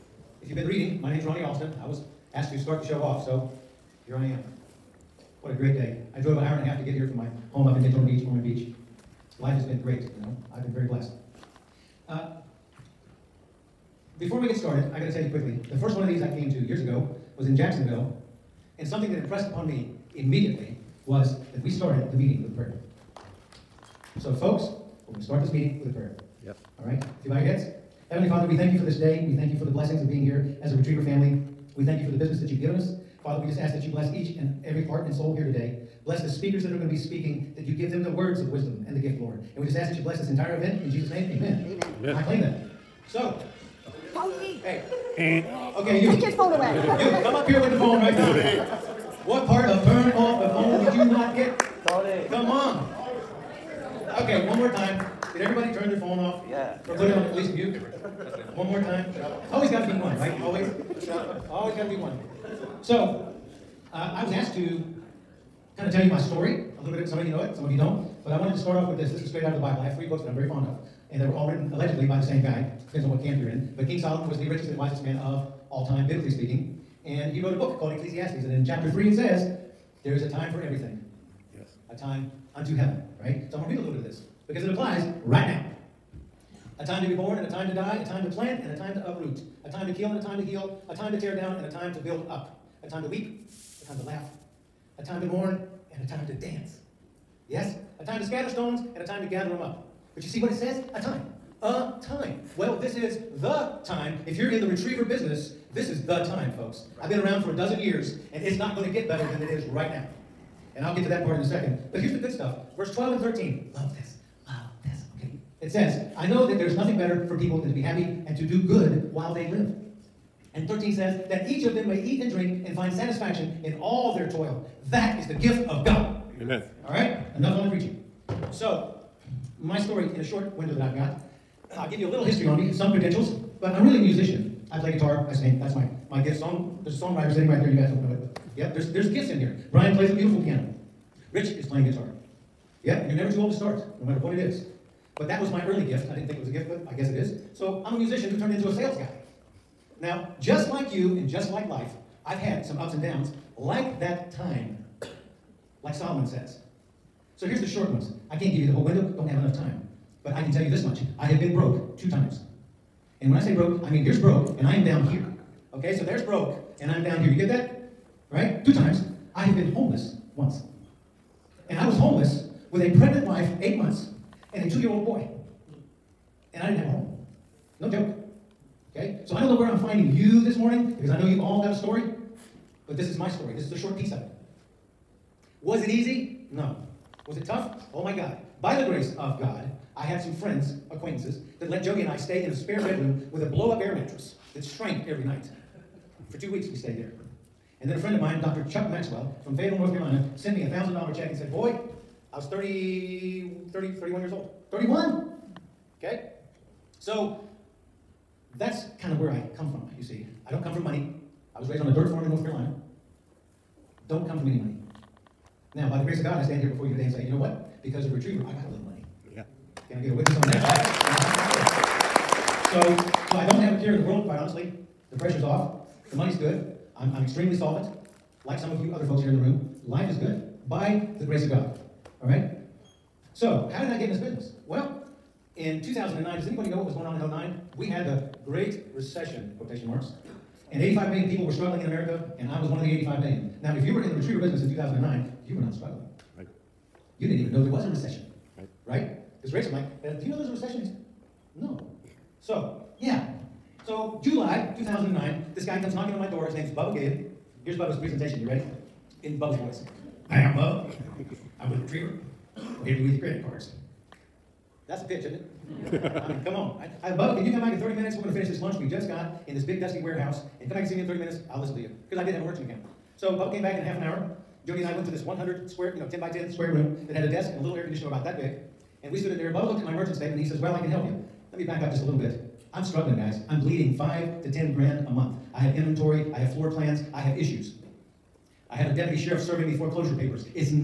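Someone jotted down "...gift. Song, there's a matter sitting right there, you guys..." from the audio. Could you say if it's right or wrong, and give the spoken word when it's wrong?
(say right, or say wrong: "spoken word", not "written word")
wrong: "songwriter", not "matter".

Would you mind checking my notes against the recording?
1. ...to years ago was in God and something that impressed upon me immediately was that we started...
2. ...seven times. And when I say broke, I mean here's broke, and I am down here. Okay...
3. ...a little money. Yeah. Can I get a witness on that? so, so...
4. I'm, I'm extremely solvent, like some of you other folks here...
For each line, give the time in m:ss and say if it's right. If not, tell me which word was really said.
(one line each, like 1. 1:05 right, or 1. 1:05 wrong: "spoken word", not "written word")
1. 0:16 wrong: "Jacksonville", not "God"
2. 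2:41 wrong: "two", not "seven"
3. 3:38 right
4. 3:46 right.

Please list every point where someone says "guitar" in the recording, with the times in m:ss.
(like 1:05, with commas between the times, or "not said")
2:14, 2:21.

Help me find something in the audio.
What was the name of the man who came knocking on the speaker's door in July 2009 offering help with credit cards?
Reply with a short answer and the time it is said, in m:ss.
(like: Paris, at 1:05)
Bubba Gabe, at 4:16.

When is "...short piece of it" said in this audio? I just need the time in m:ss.
3:03.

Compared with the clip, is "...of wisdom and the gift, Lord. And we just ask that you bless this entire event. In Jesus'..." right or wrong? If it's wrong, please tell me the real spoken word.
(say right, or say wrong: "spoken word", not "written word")
right.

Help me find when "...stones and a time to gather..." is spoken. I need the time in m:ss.
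1:38.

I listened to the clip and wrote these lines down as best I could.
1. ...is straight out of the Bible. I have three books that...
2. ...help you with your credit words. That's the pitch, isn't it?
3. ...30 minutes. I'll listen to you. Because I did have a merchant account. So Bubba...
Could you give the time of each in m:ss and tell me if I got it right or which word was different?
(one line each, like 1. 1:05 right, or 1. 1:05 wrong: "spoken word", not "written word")
1. 1:09 right
2. 4:22 wrong: "cards", not "words"
3. 4:31 right.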